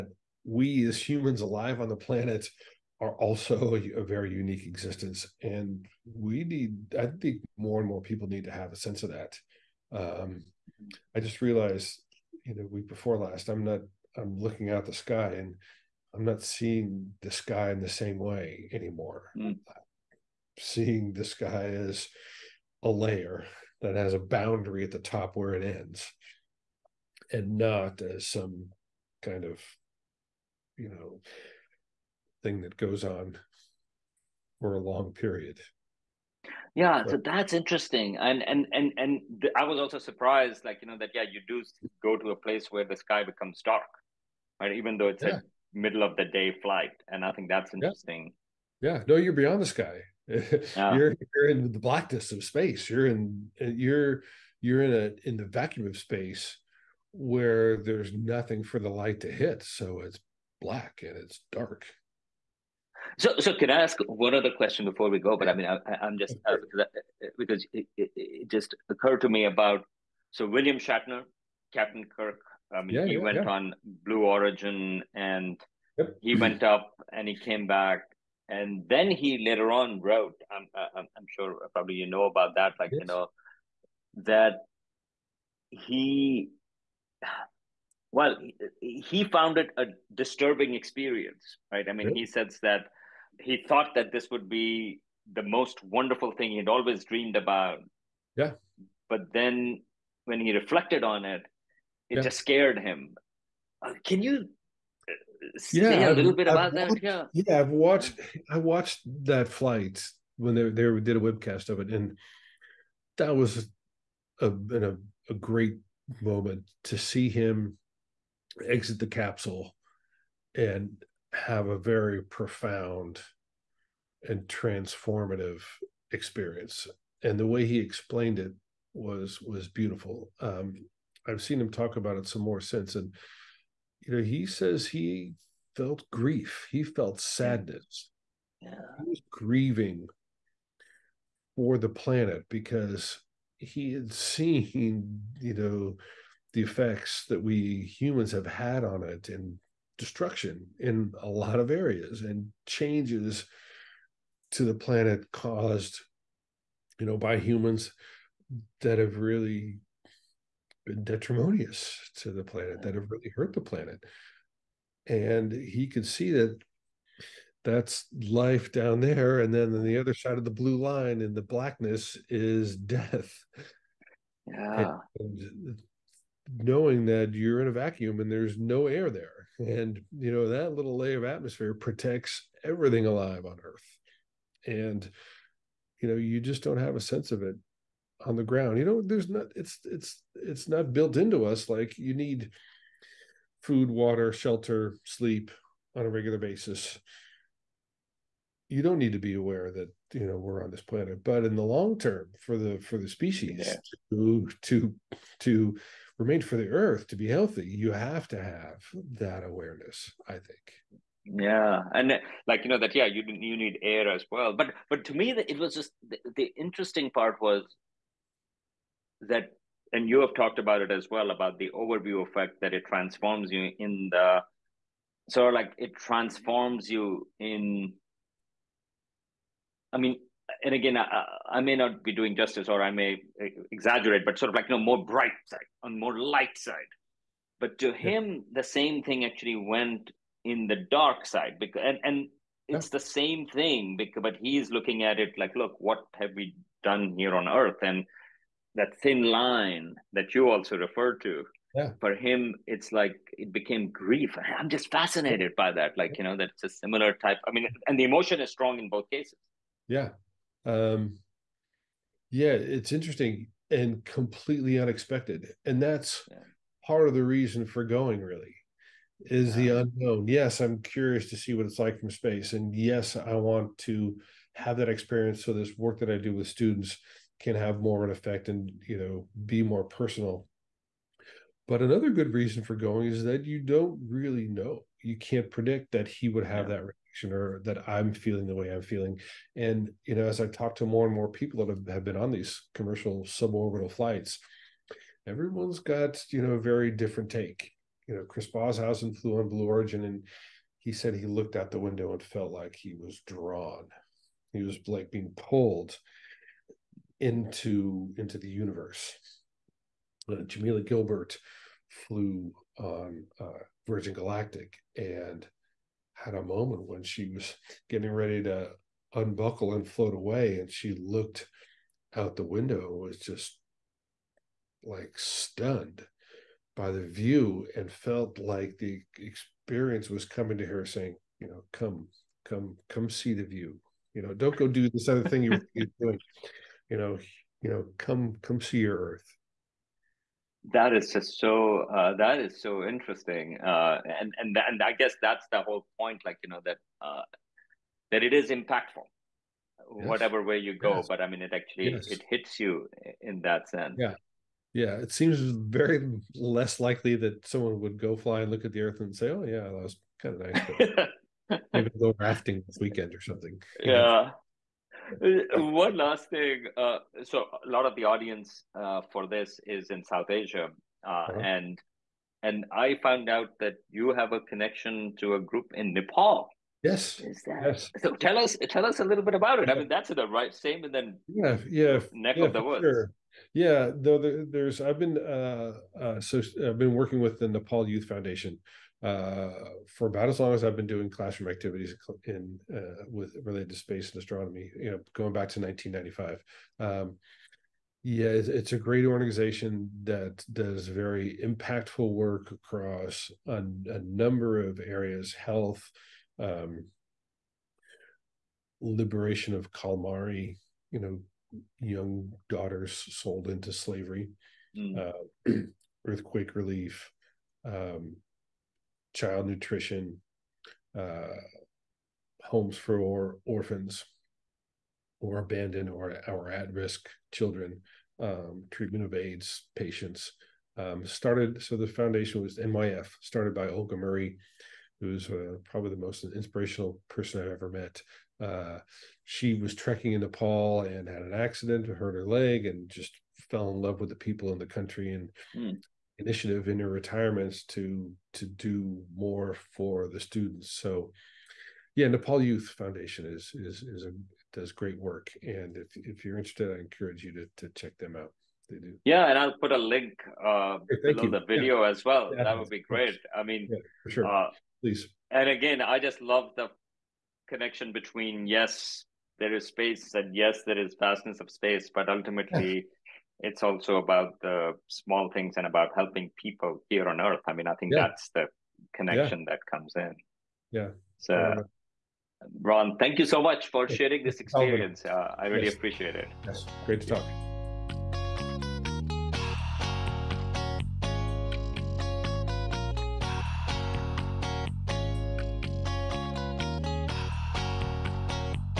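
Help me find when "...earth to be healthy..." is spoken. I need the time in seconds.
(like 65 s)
206 s.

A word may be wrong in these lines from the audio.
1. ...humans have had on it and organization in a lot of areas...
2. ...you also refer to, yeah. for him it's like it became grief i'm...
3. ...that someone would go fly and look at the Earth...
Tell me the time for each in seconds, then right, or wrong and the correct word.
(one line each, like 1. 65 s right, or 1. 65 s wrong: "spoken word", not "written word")
1. 147 s wrong: "destruction", not "organization"
2. 250 s right
3. 357 s right.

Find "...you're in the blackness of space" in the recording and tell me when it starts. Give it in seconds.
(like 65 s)
51 s.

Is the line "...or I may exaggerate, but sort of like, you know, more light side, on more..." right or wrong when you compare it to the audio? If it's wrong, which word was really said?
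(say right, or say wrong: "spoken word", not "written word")
wrong: "bright", not "light".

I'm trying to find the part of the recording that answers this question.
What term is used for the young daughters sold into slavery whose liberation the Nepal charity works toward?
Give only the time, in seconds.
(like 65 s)
409 s.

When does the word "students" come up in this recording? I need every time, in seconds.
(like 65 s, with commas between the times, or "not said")
276 s, 450 s.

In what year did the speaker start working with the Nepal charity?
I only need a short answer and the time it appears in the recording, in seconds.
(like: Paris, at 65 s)
1995, at 395 s.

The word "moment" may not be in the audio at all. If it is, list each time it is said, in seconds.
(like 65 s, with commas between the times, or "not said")
116 s, 316 s.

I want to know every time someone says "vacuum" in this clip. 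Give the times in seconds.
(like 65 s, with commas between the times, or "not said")
55 s, 177 s.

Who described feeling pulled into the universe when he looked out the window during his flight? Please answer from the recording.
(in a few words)
Chris Boshuizen.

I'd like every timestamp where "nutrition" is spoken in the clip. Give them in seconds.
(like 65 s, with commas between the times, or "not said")
419 s.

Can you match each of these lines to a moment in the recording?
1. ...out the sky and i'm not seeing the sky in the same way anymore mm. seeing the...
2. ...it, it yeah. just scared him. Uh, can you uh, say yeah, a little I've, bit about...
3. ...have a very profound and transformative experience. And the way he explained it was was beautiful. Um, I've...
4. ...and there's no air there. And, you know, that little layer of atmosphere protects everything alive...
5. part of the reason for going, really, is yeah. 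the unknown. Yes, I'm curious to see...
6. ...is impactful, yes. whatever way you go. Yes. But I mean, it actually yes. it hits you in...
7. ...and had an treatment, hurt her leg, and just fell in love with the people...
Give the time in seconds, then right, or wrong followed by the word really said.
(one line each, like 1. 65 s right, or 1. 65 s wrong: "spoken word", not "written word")
1. 14 s right
2. 101 s right
3. 121 s right
4. 178 s right
5. 266 s right
6. 348 s right
7. 440 s wrong: "accident", not "treatment".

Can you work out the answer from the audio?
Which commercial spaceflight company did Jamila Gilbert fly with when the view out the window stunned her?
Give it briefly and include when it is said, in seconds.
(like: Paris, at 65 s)
Virgin Galactic, at 313 s.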